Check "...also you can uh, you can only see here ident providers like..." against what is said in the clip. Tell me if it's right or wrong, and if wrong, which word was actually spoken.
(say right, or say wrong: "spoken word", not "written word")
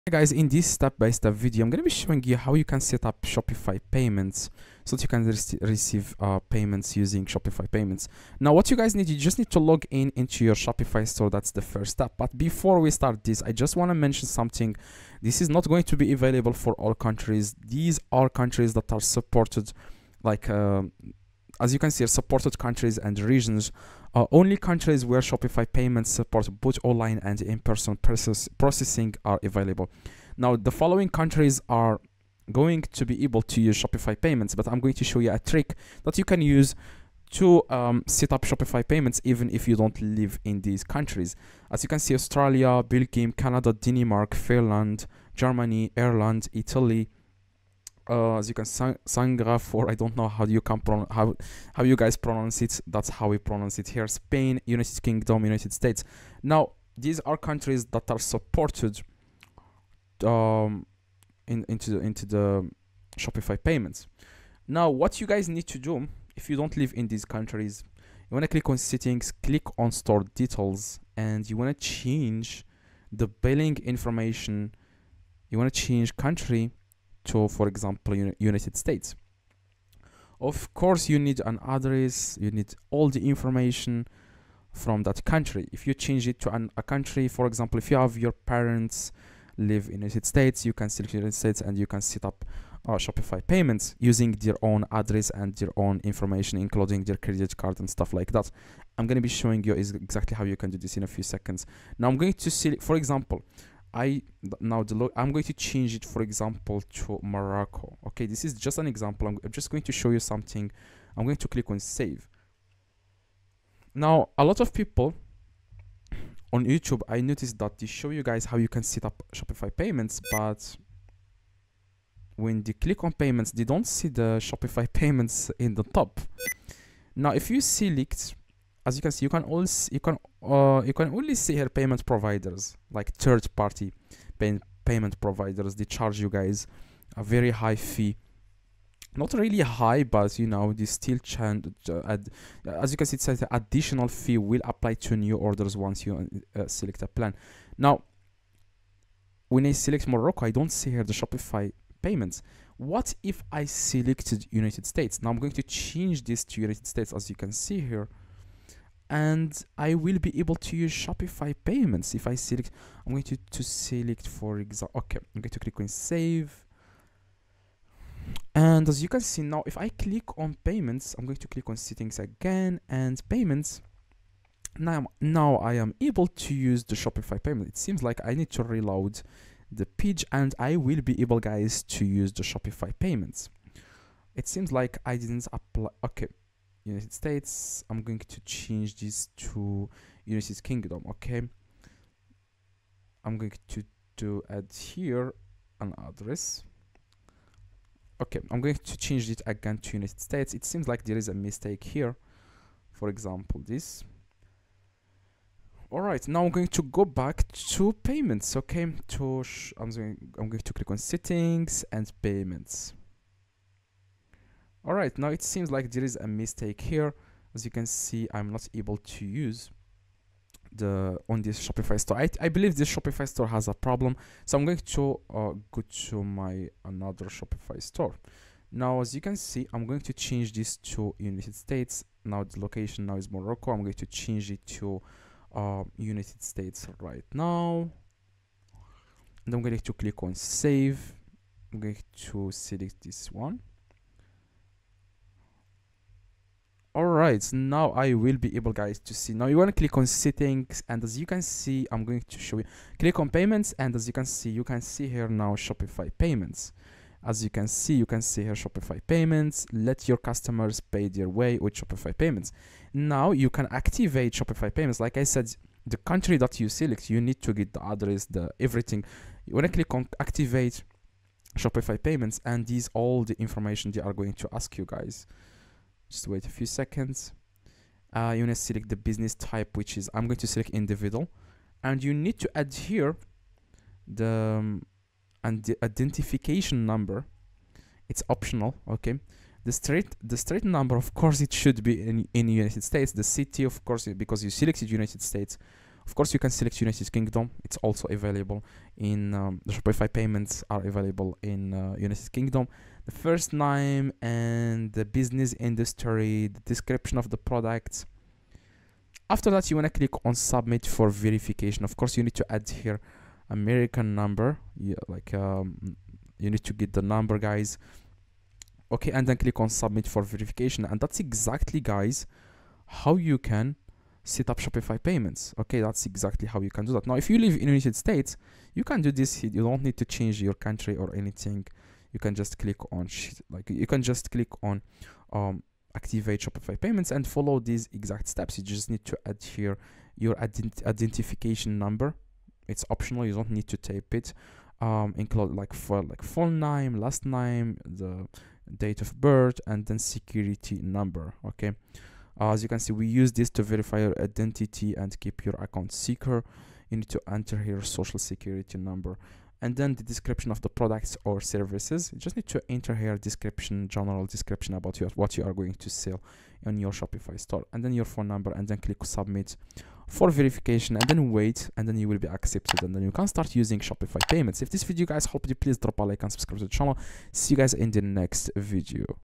wrong: "payment", not "ident".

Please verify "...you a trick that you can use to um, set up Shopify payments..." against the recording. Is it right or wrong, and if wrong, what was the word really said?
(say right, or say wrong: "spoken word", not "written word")
right.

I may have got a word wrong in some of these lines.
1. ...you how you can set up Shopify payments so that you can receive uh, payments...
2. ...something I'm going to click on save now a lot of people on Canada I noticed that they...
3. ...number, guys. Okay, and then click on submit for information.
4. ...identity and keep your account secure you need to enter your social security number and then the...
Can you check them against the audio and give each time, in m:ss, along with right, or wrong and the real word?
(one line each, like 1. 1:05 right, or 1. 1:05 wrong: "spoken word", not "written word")
1. 0:02 right
2. 1:50 wrong: "YouTube", not "Canada"
3. 5:17 wrong: "verification", not "information"
4. 5:54 right.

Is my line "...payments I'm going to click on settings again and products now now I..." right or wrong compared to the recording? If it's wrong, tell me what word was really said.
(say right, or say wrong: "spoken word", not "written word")
wrong: "payments", not "products".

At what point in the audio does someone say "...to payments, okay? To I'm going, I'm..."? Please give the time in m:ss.
3:27.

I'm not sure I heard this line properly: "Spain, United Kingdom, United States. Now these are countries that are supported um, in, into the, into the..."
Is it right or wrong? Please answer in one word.
right.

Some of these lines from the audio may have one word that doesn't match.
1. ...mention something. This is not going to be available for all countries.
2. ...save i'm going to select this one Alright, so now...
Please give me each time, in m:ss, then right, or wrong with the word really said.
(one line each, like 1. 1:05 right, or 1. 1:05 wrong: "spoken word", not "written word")
1. 0:13 right
2. 4:00 right.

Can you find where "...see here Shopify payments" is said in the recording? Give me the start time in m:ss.
4:18.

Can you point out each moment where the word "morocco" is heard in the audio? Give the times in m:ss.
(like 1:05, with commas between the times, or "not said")
1:47, 2:30, 3:53.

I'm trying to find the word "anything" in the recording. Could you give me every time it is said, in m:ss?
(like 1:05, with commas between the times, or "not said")
5:31.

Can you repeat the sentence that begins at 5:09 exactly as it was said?
After that, you want to click on submit for verification.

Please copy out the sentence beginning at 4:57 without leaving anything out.
It's also available in um, the Shopify payments are available in uh, United Kingdom.